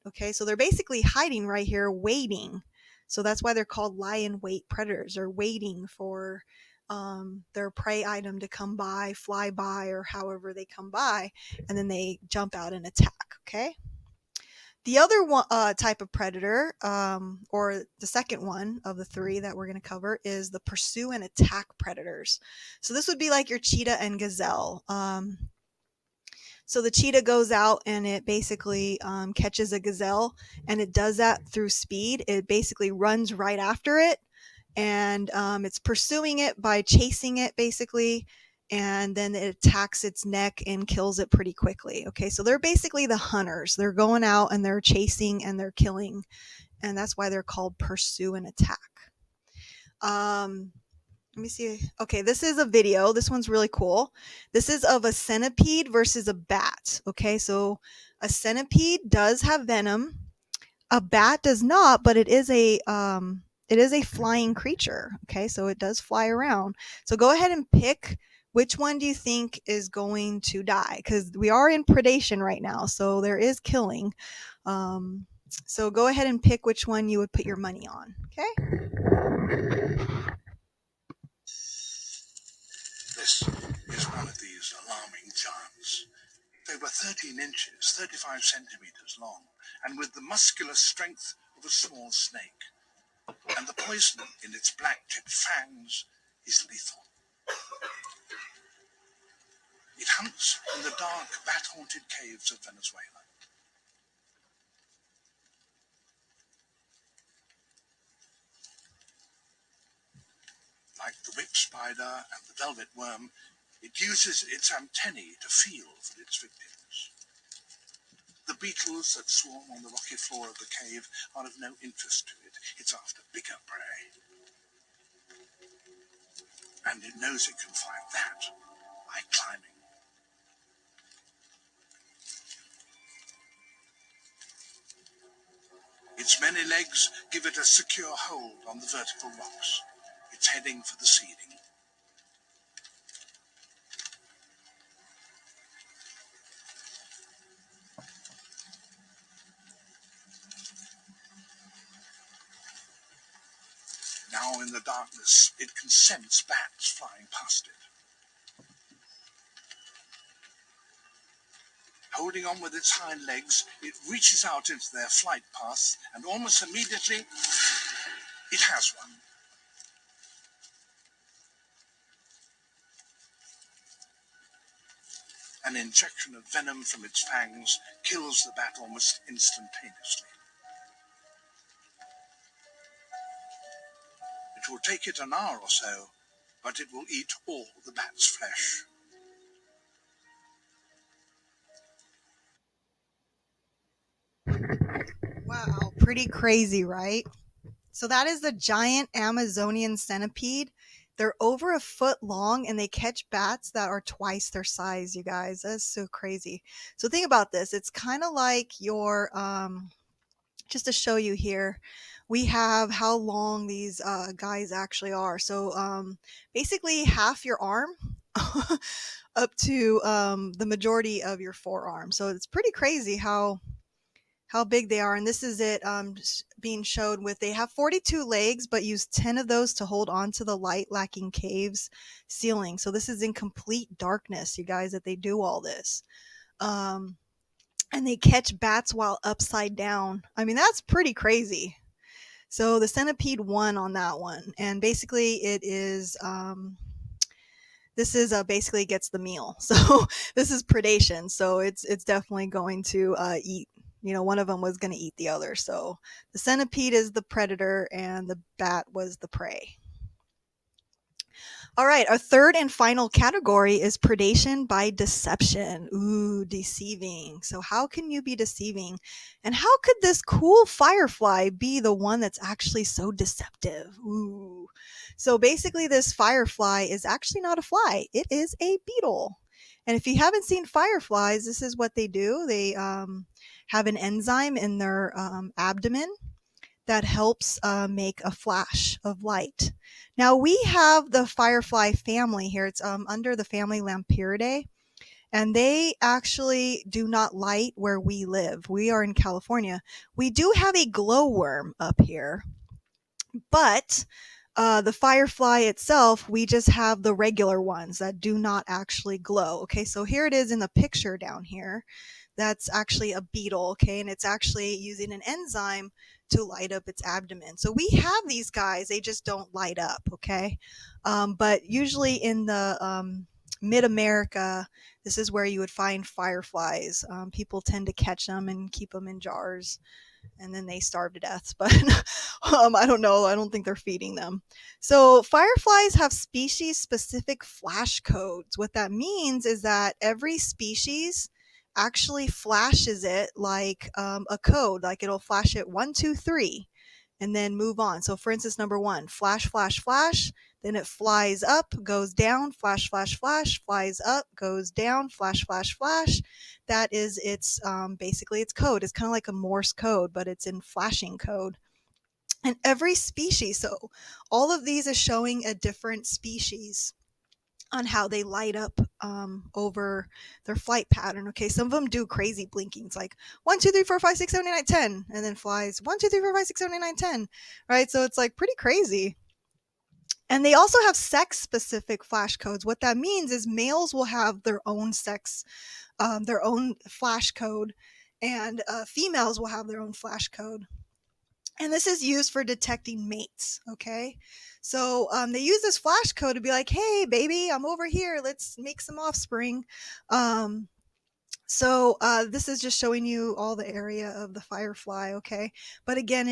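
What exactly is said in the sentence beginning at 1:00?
A bat does not, but it is a um, it is a flying creature.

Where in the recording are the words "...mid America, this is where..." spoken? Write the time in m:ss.
5:23.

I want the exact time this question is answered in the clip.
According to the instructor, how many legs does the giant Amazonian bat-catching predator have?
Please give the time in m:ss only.
3:47.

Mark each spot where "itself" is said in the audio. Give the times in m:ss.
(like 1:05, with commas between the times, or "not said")
5:05.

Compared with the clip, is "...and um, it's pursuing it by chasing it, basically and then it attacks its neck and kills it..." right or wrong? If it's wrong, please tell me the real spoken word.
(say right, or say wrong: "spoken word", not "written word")
right.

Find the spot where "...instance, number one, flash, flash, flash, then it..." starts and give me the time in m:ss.
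5:48.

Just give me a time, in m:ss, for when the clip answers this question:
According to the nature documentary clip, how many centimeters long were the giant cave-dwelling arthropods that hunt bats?
1:27.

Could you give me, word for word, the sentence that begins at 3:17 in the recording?
So that is the giant Amazonian centipede.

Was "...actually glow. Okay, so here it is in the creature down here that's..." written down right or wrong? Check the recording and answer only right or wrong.
wrong.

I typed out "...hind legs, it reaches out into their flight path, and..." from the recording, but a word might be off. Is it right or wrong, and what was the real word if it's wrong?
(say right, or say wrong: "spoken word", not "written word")
right.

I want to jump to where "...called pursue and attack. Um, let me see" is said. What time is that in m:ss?
0:47.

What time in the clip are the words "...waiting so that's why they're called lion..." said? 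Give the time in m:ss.
0:01.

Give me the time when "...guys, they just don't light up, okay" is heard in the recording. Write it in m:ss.
5:18.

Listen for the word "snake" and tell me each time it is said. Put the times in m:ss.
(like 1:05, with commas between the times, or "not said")
1:32.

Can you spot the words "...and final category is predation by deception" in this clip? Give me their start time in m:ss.
4:22.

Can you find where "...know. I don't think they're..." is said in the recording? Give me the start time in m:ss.
5:32.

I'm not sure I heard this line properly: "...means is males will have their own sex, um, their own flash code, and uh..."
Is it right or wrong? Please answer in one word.
right.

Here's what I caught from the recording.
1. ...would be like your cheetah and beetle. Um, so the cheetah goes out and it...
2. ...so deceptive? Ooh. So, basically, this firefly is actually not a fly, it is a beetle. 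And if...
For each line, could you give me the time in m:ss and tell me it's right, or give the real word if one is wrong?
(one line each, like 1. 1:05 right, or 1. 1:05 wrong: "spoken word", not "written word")
1. 0:23 wrong: "gazelle", not "beetle"
2. 4:32 right.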